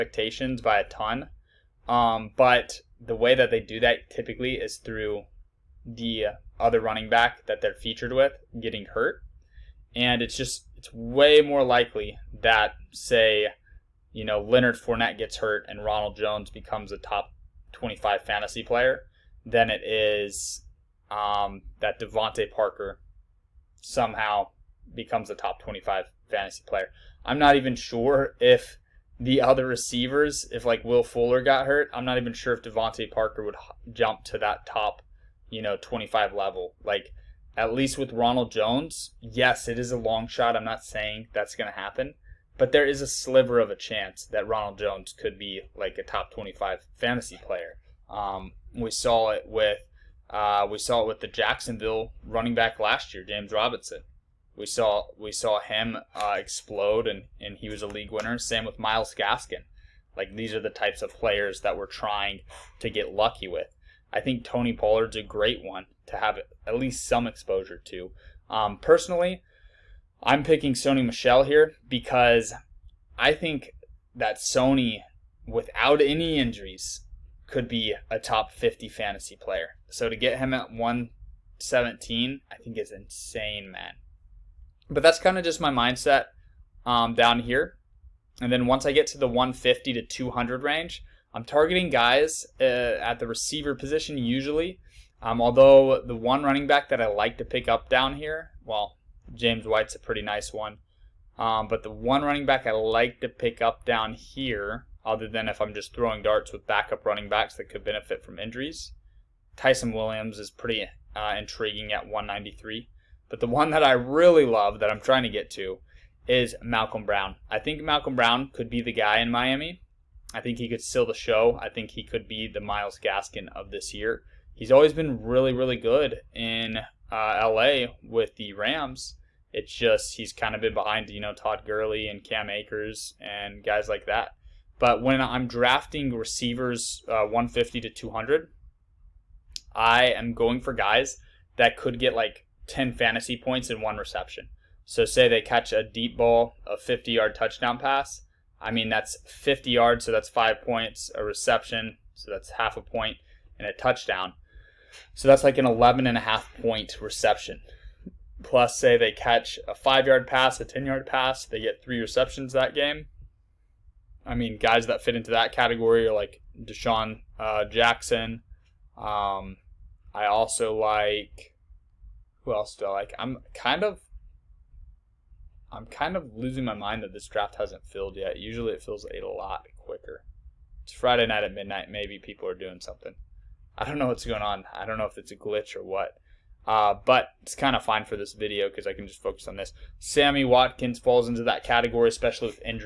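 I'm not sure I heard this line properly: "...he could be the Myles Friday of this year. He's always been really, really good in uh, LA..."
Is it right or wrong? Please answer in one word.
wrong.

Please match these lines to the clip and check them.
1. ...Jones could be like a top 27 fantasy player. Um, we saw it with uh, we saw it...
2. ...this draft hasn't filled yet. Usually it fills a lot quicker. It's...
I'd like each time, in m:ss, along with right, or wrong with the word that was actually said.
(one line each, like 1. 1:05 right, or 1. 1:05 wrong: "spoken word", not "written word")
1. 0:44 wrong: "25", not "27"
2. 2:57 right.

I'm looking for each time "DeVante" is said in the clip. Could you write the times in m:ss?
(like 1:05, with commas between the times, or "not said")
0:21, 0:32.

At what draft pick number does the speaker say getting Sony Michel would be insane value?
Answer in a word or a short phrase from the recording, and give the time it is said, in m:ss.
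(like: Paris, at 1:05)
117, at 1:20.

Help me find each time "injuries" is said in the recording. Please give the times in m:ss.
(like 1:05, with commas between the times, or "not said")
1:16, 1:48.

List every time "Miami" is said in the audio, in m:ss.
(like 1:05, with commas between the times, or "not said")
1:59.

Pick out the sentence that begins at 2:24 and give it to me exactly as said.
So, say they catch a deep ball, a 50 yard touchdown pass.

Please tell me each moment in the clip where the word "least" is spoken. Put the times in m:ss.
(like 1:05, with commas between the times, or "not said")
0:37, 1:06.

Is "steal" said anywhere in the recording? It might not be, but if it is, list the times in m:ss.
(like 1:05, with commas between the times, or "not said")
2:00.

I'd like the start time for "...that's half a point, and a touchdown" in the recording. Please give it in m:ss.
2:32.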